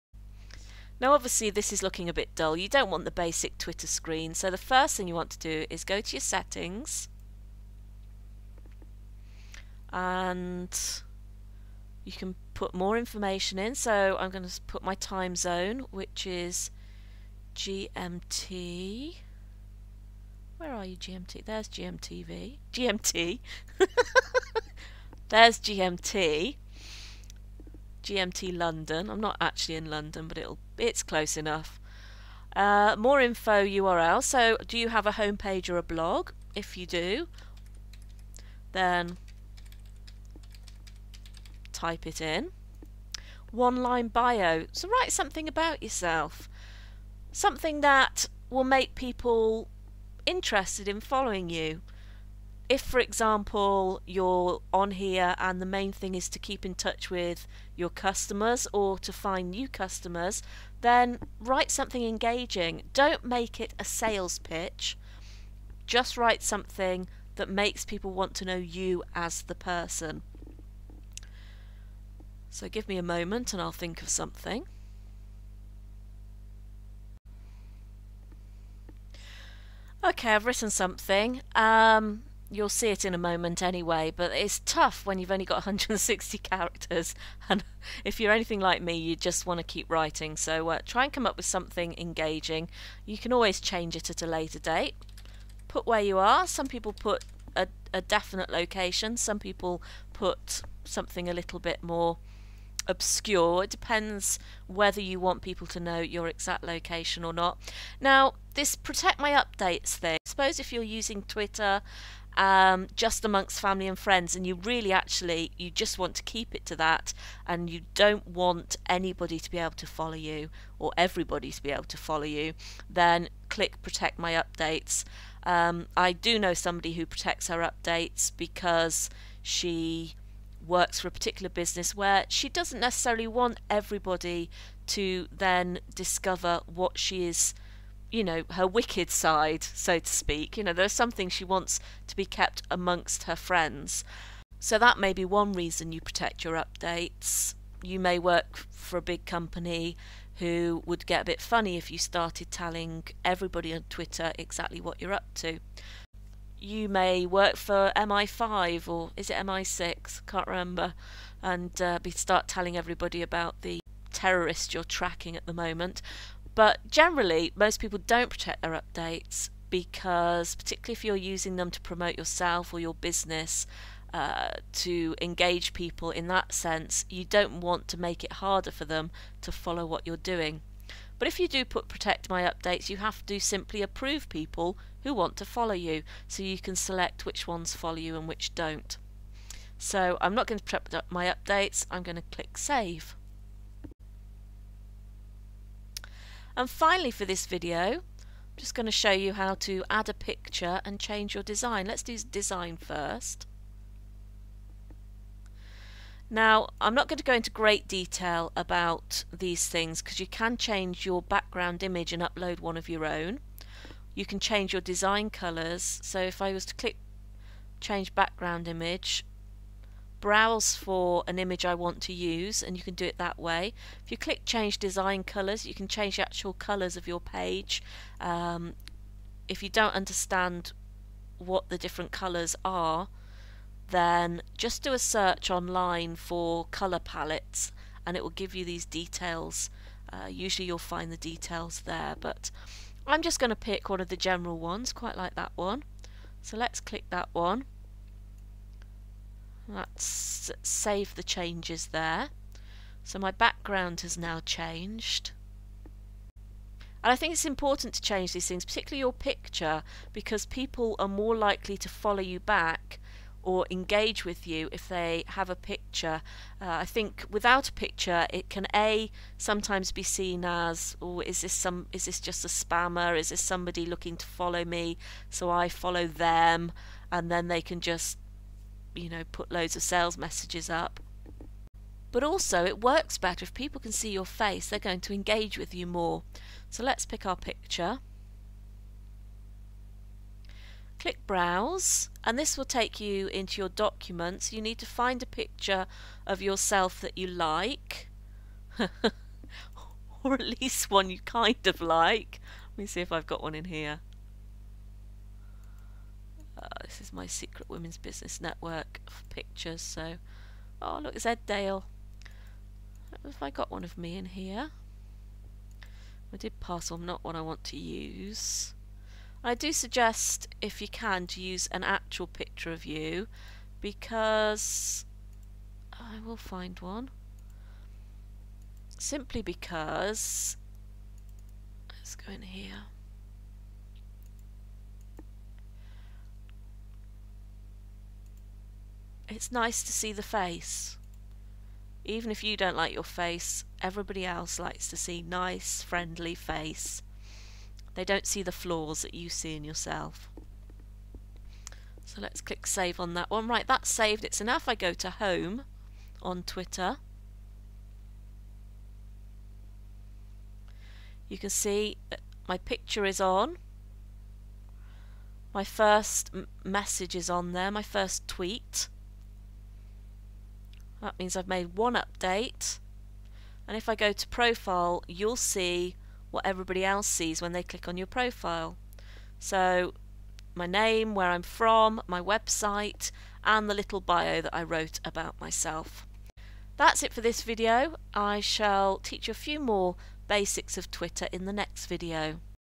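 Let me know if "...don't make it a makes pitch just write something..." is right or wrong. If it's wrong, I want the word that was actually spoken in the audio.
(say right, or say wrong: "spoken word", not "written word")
wrong: "sales", not "makes".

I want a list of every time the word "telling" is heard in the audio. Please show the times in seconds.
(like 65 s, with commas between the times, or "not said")
152 s, 162 s.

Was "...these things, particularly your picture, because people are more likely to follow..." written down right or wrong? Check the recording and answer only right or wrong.
right.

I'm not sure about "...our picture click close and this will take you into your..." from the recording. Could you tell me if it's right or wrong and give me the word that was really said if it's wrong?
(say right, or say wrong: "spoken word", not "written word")
wrong: "browse", not "close".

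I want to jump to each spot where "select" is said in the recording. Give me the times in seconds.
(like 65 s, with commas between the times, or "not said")
186 s.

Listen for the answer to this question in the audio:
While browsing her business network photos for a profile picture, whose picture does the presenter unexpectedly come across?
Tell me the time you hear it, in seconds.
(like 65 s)
311 s.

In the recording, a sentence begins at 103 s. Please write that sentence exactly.
It depends whether you want people to know your exact location or not.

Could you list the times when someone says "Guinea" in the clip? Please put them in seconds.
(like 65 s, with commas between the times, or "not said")
not said.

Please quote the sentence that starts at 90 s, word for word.
So uh, try and come up with something engaging.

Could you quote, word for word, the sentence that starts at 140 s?
You know, there are some things she wants to be kept amongst her friends.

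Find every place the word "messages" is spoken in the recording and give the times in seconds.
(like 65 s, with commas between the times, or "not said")
280 s, 366 s.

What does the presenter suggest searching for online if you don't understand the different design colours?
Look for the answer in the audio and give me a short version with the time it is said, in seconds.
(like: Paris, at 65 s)
color palettes, at 236 s.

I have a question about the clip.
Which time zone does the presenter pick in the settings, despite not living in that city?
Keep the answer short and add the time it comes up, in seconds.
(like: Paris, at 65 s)
GMT London, at 28 s.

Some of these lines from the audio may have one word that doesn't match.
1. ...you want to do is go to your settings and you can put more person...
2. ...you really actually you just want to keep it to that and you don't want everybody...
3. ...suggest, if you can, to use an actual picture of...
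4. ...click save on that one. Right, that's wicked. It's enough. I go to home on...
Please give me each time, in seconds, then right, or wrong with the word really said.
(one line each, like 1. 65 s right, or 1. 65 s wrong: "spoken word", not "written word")
1. 5 s wrong: "information", not "person"
2. 114 s wrong: "anybody", not "everybody"
3. 319 s right
4. 352 s wrong: "saved", not "wicked".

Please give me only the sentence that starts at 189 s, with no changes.
So I'm not going to protect my updates, I'm going to click save.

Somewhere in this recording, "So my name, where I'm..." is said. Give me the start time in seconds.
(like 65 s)
379 s.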